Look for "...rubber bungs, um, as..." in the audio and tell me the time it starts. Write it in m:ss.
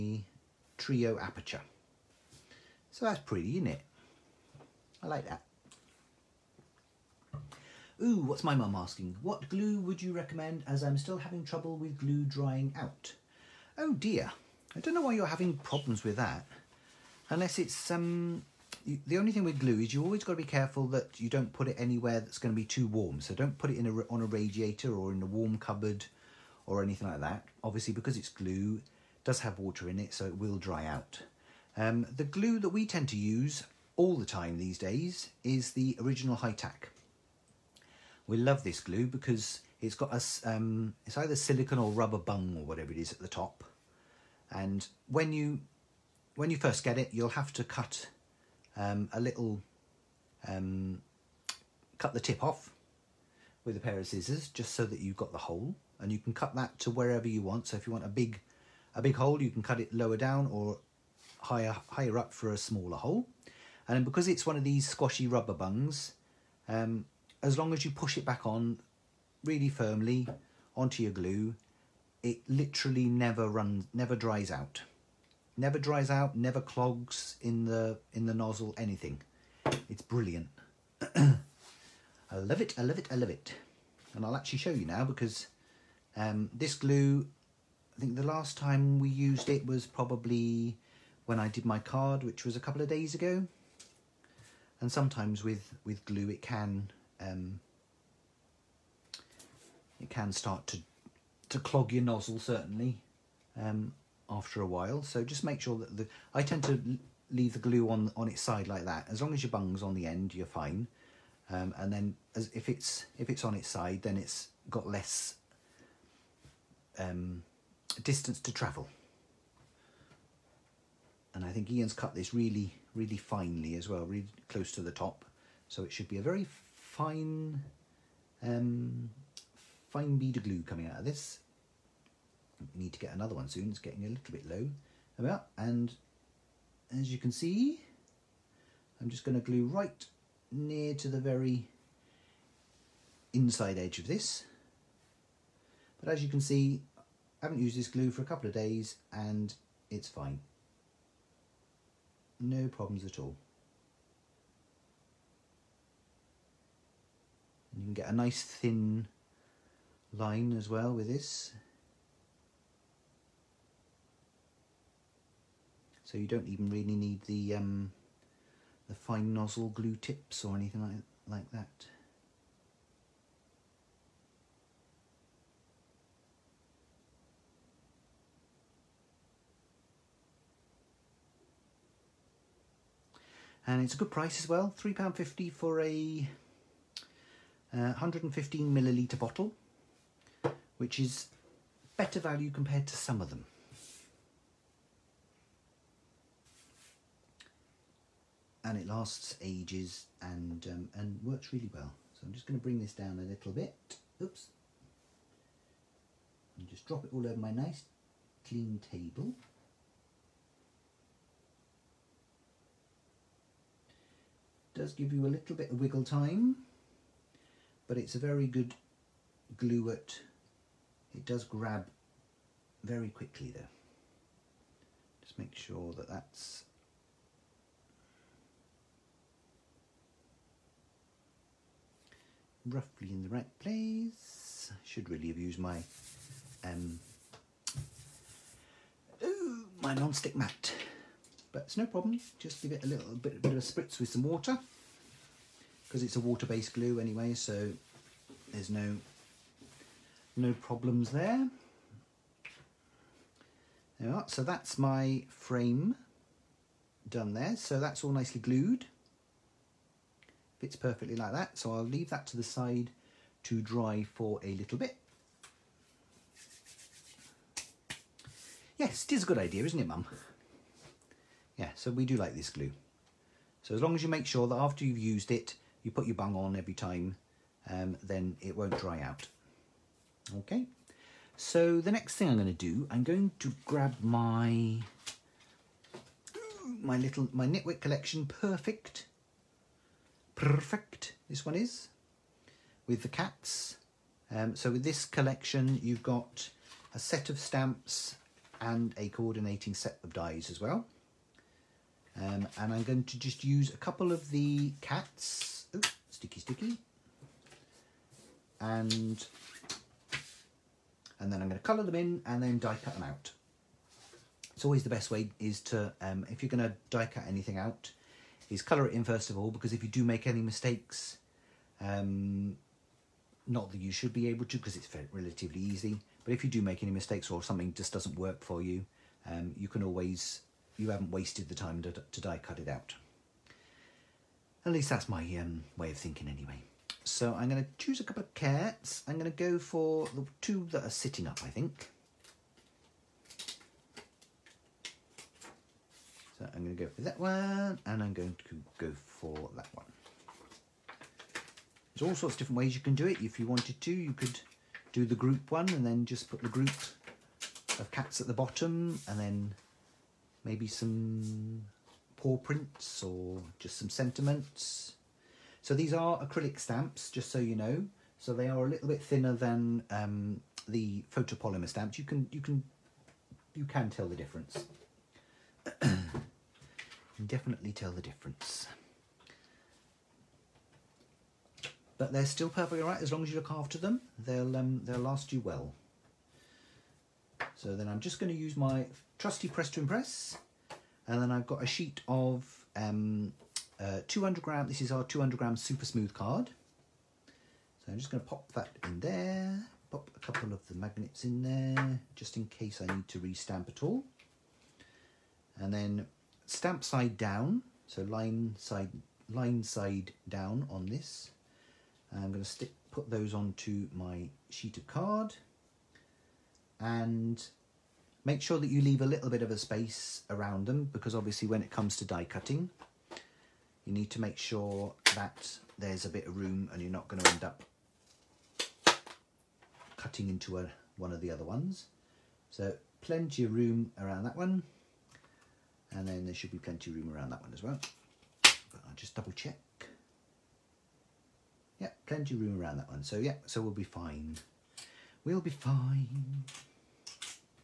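1:05.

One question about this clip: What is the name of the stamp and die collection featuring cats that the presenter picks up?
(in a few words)
Nitwit collection.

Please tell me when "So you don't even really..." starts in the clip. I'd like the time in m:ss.
2:46.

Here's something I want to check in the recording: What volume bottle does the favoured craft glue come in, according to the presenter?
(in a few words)
115 milliliters.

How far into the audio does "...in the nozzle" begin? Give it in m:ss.
1:18.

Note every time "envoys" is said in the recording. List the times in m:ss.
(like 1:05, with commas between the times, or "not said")
not said.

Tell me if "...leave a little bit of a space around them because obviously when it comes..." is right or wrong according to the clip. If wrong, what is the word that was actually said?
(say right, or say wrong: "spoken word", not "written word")
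right.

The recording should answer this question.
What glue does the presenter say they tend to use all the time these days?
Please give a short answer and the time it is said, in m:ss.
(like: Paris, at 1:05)
Original High Tack, at 0:36.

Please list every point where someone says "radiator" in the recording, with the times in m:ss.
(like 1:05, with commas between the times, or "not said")
0:24.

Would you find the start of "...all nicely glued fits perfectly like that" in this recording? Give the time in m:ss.
4:18.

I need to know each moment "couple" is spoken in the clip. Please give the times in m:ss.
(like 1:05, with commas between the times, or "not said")
1:32, 2:28, 5:03, 5:38, 6:40.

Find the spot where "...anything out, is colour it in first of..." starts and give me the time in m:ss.
5:17.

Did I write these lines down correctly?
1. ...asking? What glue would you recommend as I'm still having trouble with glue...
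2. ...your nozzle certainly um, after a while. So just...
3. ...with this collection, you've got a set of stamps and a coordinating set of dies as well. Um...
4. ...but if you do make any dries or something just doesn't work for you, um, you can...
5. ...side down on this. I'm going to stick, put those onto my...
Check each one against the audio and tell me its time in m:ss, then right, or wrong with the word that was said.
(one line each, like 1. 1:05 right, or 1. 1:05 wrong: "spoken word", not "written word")
1. 0:08 right
2. 1:41 right
3. 4:54 right
4. 5:26 wrong: "mistakes", not "dries"
5. 6:49 right.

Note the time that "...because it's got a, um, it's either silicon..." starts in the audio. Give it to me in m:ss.
0:39.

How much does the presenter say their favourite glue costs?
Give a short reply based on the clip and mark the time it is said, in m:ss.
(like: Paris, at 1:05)
£3.50, at 3:04.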